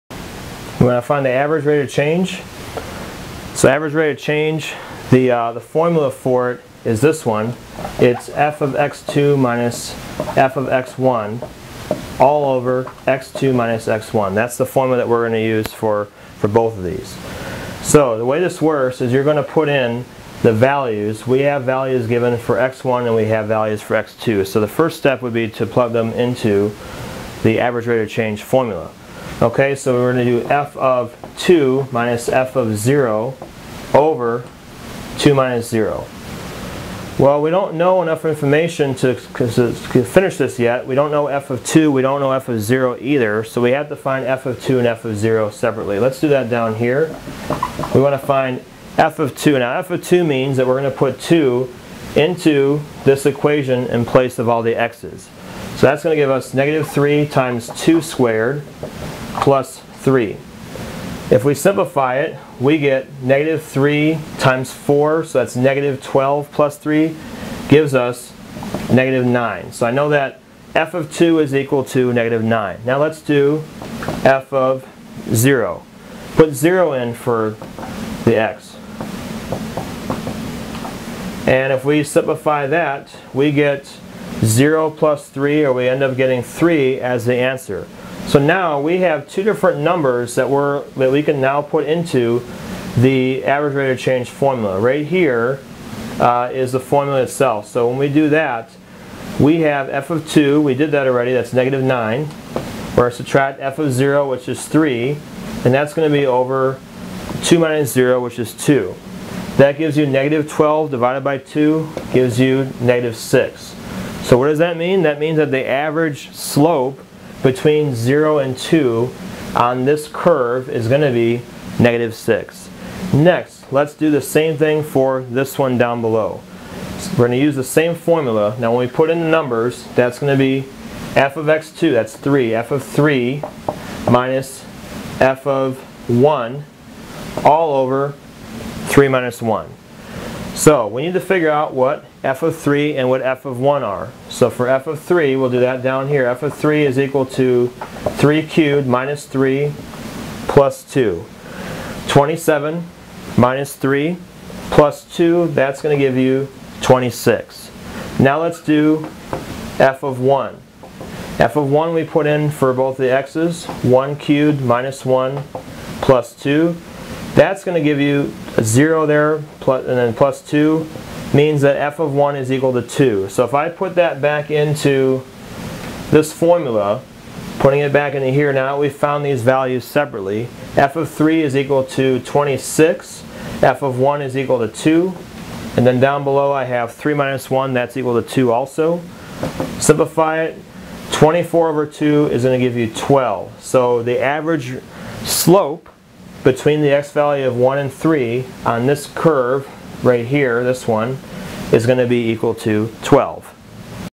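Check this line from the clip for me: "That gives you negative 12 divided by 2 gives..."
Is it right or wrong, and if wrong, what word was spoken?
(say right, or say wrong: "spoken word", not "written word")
right.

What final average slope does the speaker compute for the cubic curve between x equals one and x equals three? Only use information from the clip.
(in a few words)
12.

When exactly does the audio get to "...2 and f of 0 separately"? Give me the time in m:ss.
0:44.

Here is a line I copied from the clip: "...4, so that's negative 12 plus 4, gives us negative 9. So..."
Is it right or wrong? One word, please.
wrong.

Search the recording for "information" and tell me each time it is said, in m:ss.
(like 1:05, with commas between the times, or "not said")
0:38.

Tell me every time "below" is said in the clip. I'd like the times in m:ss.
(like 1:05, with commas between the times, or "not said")
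2:06, 3:06.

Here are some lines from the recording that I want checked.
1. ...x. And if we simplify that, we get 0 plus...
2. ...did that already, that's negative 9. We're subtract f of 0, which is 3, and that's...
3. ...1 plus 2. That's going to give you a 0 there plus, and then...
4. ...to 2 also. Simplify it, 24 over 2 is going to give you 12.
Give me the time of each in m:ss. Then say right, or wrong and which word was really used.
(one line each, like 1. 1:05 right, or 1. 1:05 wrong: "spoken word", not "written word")
1. 1:18 right
2. 1:40 right
3. 2:45 right
4. 3:08 right.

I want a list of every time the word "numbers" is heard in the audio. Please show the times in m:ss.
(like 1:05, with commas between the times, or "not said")
1:29, 2:09.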